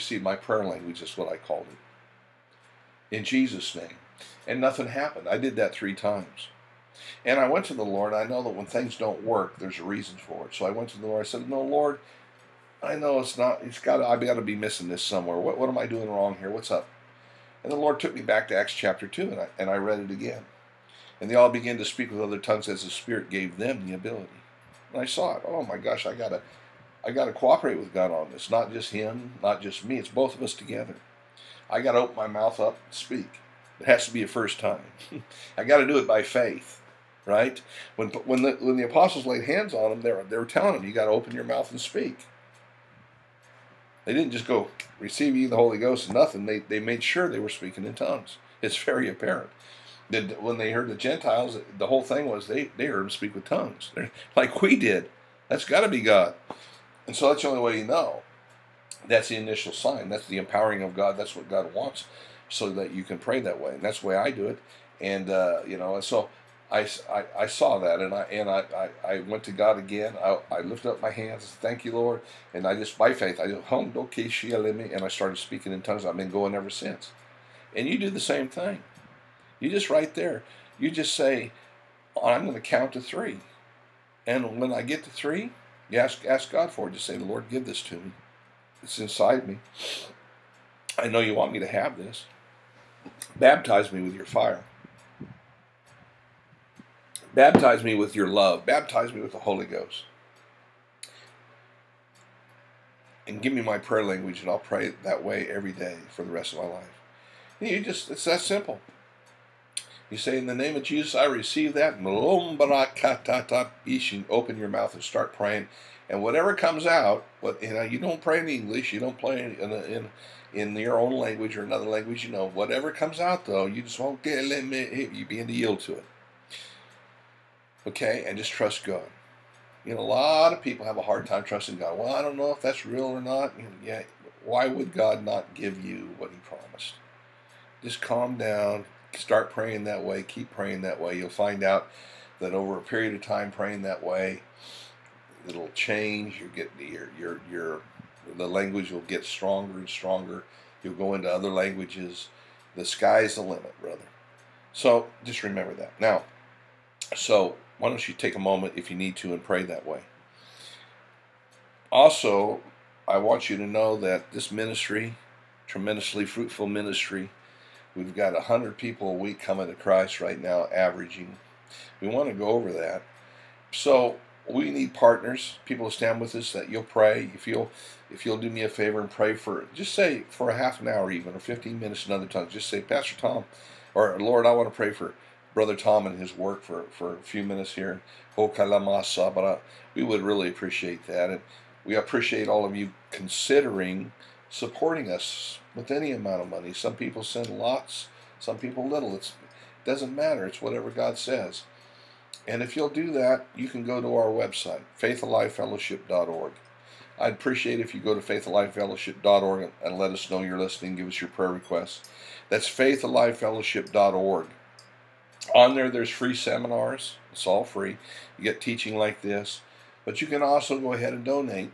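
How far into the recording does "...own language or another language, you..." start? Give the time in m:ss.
2:00.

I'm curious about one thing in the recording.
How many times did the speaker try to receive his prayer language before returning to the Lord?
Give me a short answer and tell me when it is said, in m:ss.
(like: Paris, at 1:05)
3 times, at 0:05.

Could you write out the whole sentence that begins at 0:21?
And they all began to speak with other tongues as the Spirit gave them the ability.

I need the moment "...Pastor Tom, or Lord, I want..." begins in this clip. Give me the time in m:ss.
3:02.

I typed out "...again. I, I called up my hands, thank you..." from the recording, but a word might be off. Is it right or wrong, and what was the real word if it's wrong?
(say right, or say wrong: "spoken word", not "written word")
wrong: "lifted", not "called".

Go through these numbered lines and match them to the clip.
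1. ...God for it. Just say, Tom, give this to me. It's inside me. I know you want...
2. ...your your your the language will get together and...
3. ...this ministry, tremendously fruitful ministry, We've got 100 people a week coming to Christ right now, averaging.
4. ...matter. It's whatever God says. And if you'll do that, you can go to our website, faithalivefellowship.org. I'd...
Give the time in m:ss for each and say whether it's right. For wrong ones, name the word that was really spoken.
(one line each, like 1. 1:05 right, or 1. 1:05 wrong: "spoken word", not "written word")
1. 1:26 wrong: "Lord", not "Tom"
2. 2:26 wrong: "stronger", not "together"
3. 2:44 right
4. 3:20 right.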